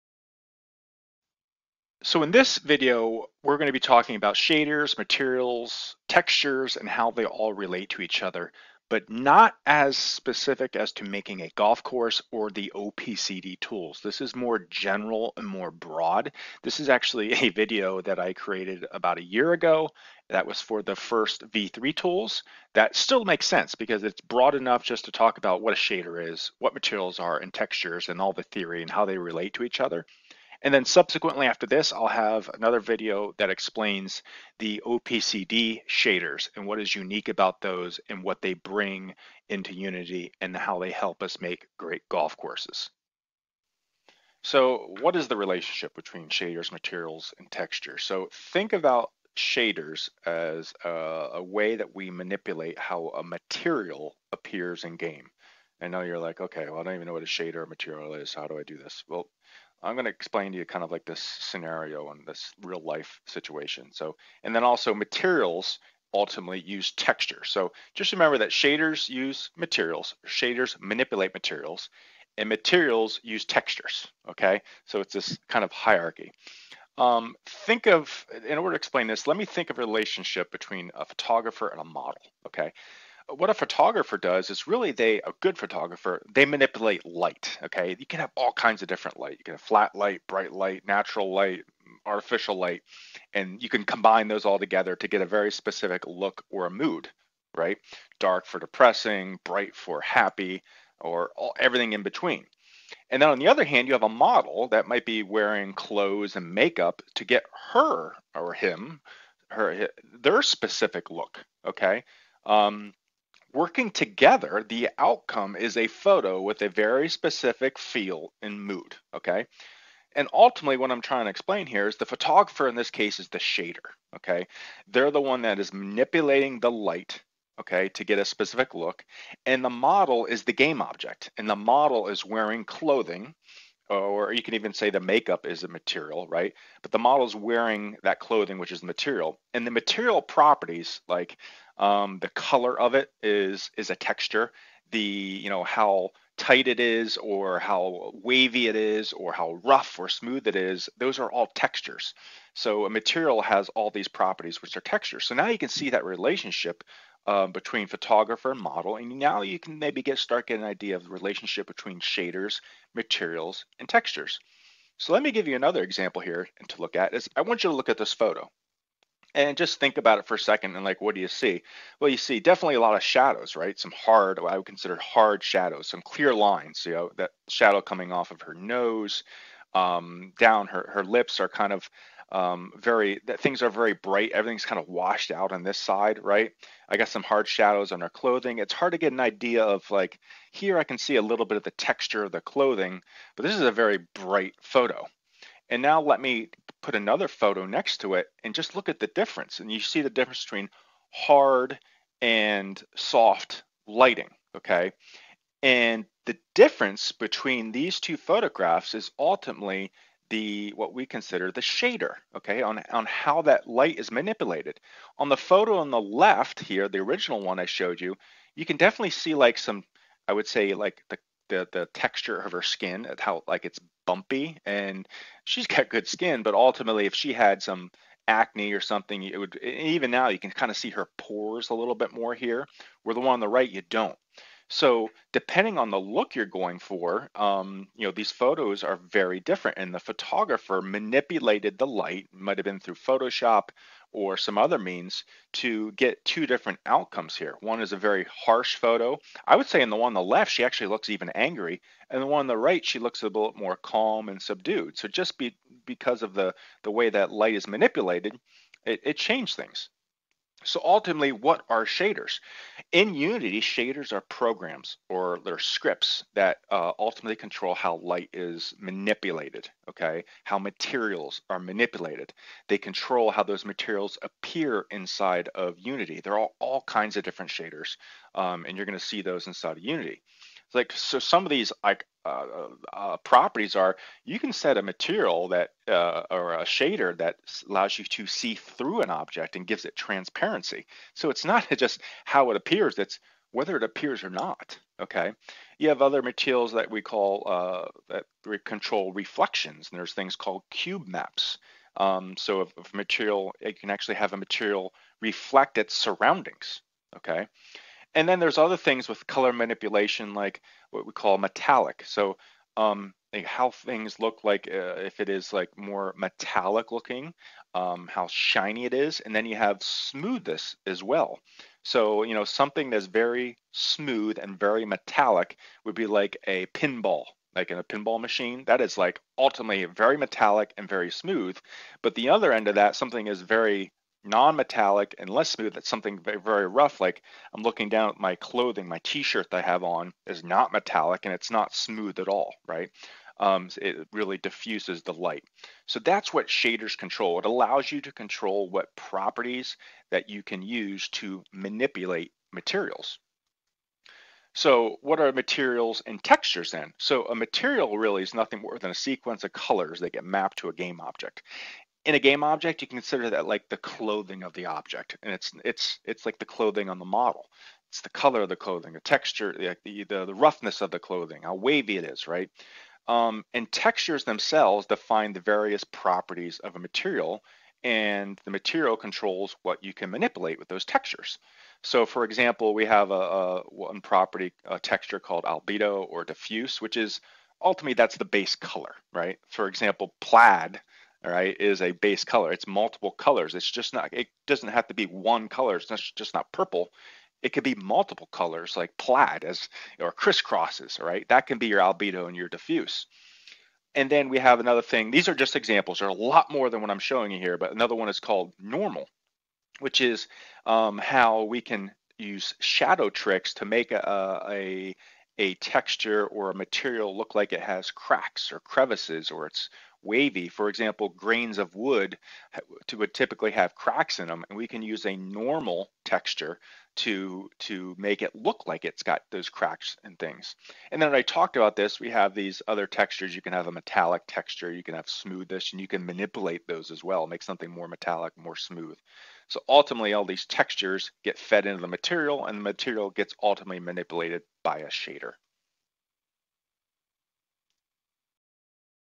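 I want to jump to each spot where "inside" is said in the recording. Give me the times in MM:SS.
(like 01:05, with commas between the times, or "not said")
04:34, 04:39.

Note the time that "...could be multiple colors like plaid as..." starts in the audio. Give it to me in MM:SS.
06:37.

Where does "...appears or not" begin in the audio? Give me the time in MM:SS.
04:53.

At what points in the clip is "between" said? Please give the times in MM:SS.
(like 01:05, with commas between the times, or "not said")
00:45, 01:20, 01:42, 02:37, 02:41, 03:20, 03:27.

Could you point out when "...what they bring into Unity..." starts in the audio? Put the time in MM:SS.
00:38.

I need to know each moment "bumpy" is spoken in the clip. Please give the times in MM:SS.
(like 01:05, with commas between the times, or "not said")
03:44.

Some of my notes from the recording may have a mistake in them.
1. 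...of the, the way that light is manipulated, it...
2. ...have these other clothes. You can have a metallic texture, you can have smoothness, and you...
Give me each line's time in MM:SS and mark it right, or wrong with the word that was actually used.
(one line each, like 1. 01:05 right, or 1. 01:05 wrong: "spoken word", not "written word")
1. 04:16 right
2. 07:12 wrong: "textures", not "clothes".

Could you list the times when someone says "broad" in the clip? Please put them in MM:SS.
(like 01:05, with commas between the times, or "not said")
00:15, 00:24.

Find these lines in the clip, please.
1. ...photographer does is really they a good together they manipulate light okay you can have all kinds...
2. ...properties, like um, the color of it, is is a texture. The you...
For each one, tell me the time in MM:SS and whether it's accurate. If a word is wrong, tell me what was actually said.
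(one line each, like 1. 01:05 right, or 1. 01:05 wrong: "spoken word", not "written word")
1. 01:23 wrong: "photographer", not "together"
2. 02:20 right.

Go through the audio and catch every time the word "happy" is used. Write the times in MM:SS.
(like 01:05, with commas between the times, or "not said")
01:40.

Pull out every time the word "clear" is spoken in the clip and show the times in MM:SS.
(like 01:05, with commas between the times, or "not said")
02:56.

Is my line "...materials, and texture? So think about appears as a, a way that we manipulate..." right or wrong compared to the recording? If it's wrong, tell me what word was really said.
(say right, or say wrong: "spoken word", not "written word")
wrong: "shaders", not "appears".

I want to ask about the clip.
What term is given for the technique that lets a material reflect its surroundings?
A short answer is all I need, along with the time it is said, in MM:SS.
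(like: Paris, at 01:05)
cube maps, at 05:00.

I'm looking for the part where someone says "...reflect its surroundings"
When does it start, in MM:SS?
05:05.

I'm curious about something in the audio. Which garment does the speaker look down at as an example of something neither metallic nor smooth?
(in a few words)
t-shirt.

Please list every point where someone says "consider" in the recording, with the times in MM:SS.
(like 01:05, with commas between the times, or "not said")
02:54, 03:31, 06:02.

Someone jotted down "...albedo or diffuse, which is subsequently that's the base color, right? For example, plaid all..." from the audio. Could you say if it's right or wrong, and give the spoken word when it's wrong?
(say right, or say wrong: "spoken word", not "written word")
wrong: "ultimately", not "subsequently".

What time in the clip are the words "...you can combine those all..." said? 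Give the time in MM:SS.
01:33.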